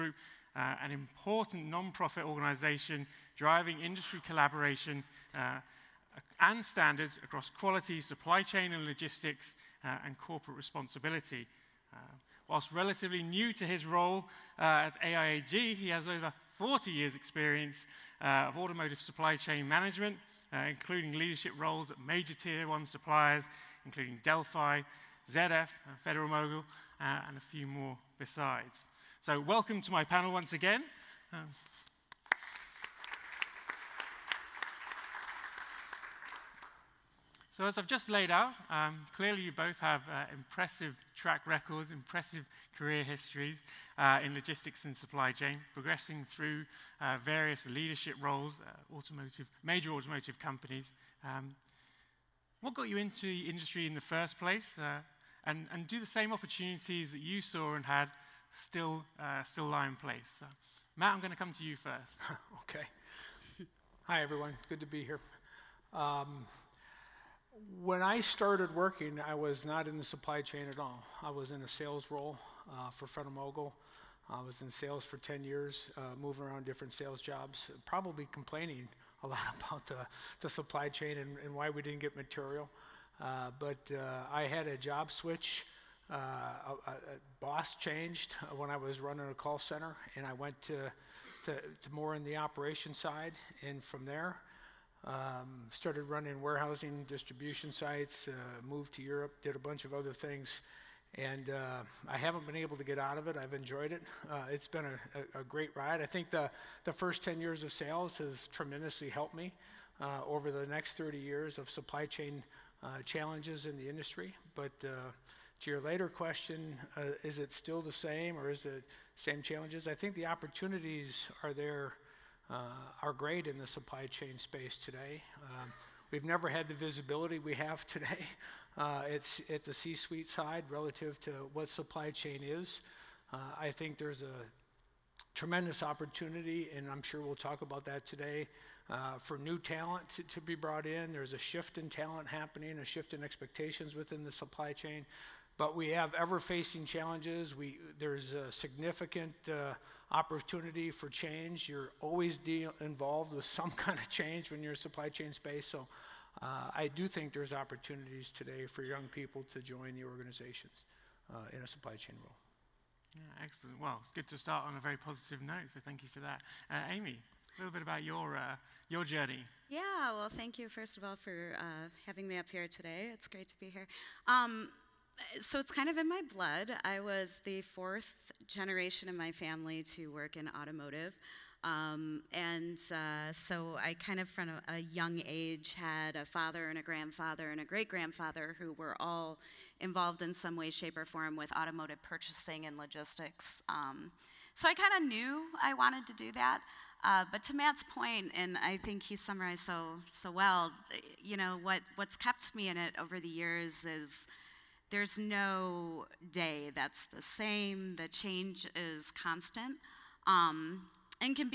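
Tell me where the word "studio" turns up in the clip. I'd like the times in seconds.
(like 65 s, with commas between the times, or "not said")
not said.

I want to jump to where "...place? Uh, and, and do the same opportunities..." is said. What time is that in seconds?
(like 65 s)
54 s.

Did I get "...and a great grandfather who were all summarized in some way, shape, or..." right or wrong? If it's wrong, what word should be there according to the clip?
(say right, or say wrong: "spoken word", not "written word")
wrong: "involved", not "summarized".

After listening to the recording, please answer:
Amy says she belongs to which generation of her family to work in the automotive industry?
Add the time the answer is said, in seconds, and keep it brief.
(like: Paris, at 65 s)
Fourth, at 177 s.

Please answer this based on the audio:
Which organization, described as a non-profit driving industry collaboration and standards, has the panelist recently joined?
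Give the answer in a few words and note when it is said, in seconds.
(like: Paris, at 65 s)
AIAG, at 15 s.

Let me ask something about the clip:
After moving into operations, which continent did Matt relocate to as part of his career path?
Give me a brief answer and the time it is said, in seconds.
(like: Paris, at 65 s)
Europe, at 98 s.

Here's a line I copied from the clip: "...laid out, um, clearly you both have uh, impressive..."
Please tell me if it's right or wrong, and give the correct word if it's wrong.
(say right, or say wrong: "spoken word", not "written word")
right.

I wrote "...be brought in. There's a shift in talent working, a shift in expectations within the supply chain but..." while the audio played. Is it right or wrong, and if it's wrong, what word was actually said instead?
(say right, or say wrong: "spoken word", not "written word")
wrong: "happening", not "working".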